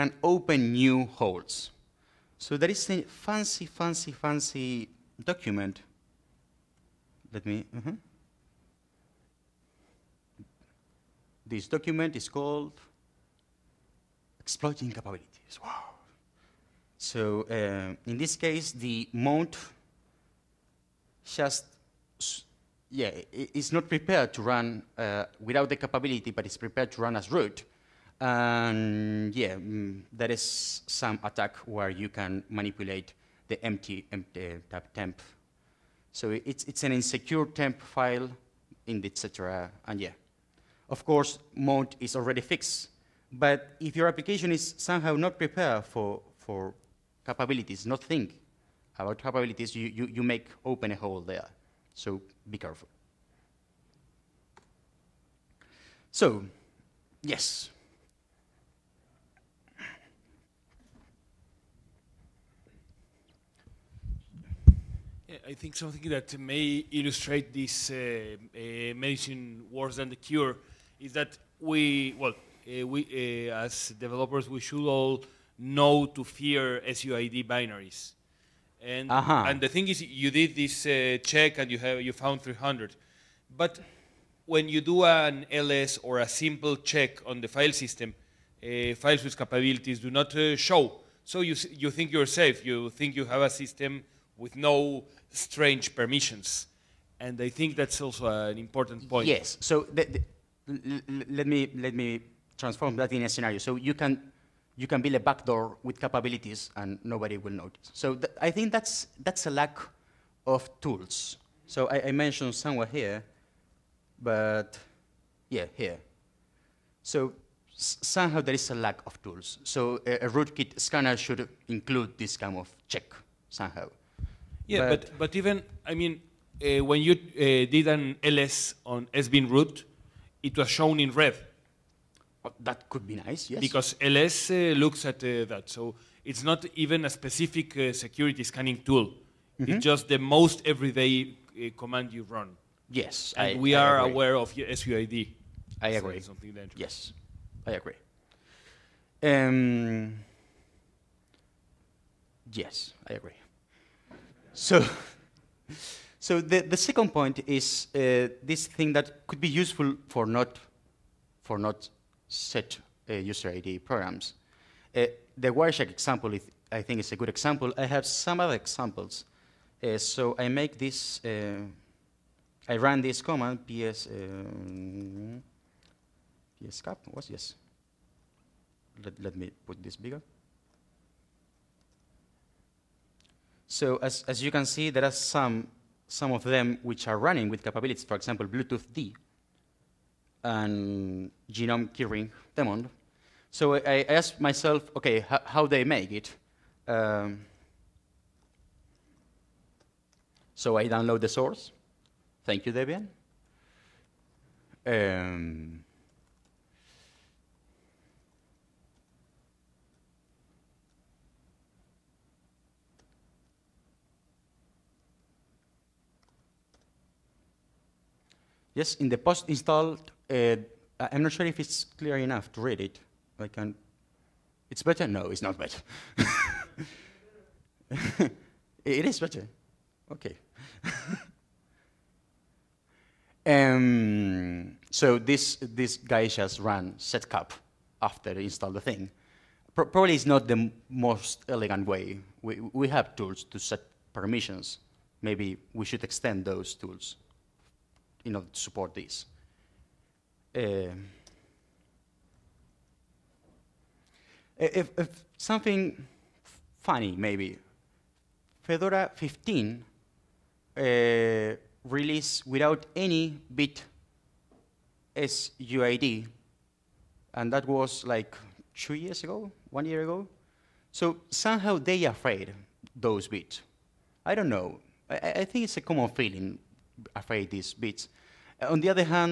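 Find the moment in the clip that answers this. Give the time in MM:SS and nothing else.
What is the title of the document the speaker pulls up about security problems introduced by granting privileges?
00:14.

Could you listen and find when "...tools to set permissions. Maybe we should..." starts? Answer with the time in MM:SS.
04:03.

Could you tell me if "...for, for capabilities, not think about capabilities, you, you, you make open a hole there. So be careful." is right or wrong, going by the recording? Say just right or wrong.
right.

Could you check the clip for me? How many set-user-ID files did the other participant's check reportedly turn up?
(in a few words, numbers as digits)
300.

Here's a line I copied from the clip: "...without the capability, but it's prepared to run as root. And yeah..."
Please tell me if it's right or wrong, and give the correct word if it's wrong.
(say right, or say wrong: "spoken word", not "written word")
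right.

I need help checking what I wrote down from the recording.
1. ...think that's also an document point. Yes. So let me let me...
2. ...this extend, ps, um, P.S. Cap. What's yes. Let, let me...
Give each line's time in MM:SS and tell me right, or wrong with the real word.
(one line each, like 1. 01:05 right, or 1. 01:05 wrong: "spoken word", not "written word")
1. 01:37 wrong: "important", not "document"
2. 02:52 wrong: "command", not "extend".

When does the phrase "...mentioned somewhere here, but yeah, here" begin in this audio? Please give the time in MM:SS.
01:52.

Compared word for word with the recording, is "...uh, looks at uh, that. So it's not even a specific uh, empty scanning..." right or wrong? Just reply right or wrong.
wrong.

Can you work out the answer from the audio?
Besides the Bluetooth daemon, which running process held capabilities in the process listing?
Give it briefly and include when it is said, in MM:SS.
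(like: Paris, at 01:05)
GNOME keyring daemon, at 03:11.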